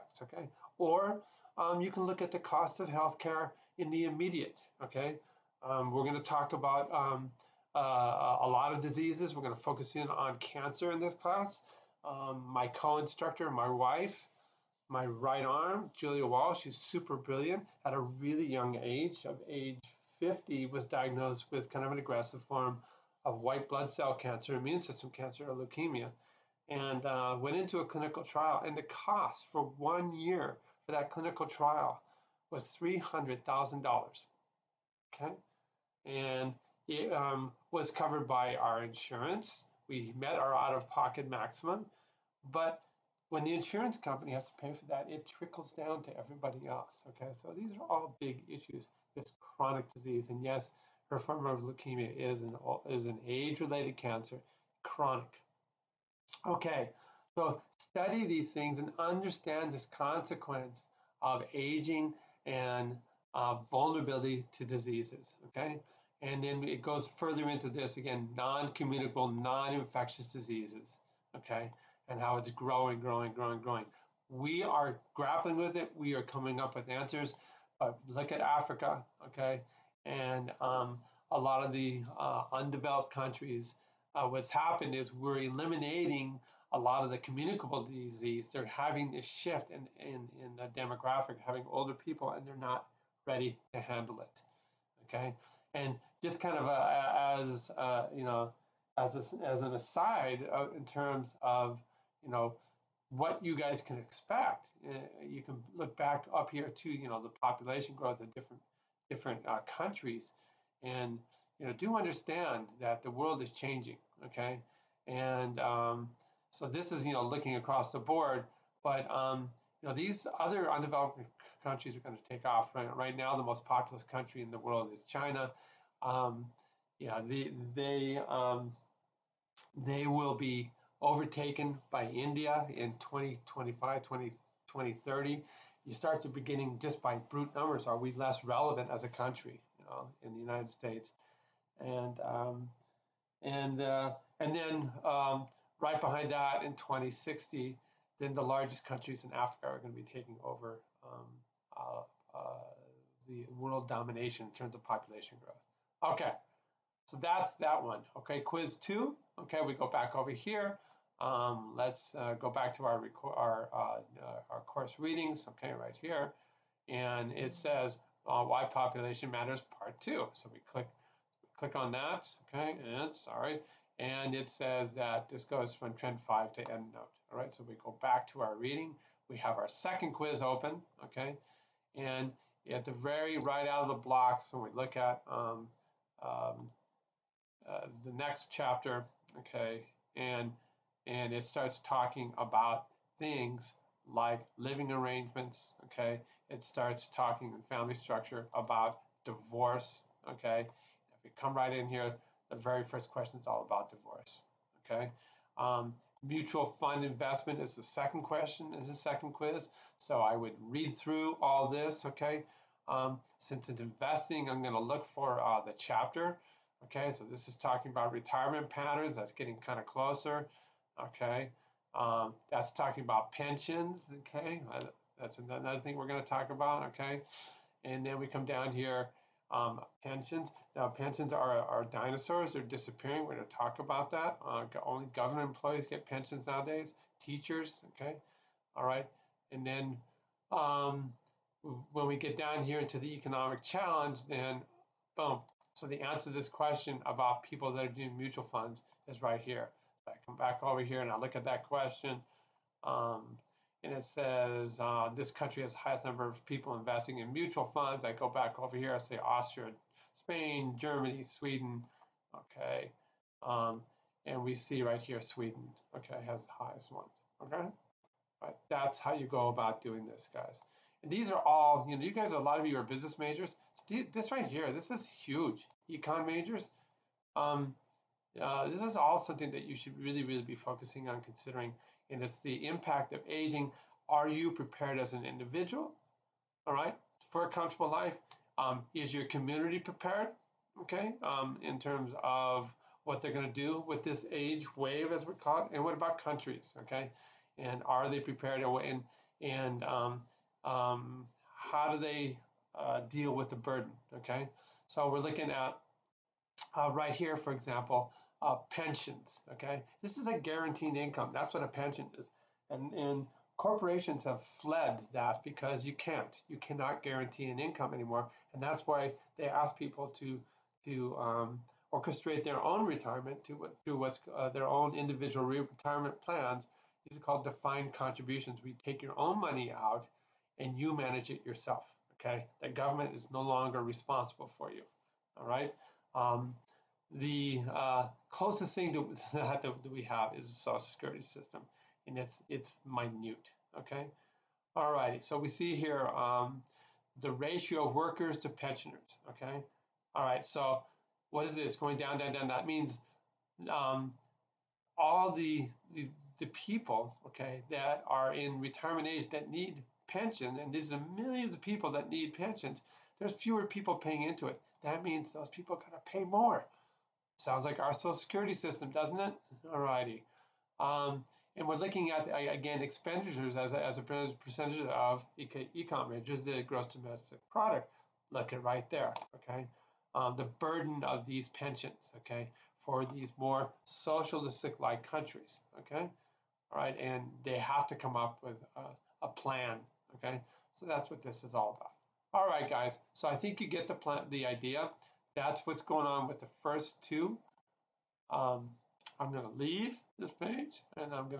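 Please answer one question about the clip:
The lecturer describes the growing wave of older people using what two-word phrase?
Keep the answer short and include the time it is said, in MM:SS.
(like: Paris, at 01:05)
age wave, at 04:54.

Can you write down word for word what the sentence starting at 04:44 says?
Are you prepared as an individual, all right, for a comfortable life?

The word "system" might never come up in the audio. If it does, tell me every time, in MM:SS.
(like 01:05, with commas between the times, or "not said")
00:24, 05:41, 06:08.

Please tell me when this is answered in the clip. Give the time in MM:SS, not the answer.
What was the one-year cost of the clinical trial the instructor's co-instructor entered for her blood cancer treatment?
00:32.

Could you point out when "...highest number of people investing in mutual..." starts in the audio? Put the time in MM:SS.
04:15.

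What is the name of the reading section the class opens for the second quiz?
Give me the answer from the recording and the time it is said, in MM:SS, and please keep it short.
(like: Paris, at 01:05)
Why population matters part two, at 02:48.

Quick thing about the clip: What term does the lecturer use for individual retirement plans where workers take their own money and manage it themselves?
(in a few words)
defined contributions.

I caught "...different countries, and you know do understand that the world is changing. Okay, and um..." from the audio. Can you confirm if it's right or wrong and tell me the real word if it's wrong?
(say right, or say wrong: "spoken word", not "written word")
right.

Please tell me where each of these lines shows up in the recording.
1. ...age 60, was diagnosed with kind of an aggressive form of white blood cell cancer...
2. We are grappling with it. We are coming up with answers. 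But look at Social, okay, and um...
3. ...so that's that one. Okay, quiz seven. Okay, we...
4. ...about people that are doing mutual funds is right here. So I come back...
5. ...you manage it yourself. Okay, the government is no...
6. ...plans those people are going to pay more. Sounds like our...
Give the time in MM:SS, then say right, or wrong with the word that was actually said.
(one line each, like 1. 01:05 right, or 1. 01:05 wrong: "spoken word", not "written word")
1. 00:19 wrong: "50", not "60"
2. 01:14 wrong: "Africa", not "Social"
3. 02:37 wrong: "two", not "seven"
4. 04:07 right
5. 05:30 right
6. 06:05 wrong: "means", not "plans".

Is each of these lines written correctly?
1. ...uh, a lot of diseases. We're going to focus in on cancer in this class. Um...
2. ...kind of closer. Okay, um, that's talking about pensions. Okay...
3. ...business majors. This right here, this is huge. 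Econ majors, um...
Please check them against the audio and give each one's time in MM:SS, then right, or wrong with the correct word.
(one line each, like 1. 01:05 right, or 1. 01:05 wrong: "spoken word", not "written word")
1. 00:07 right
2. 03:39 right
3. 04:32 right.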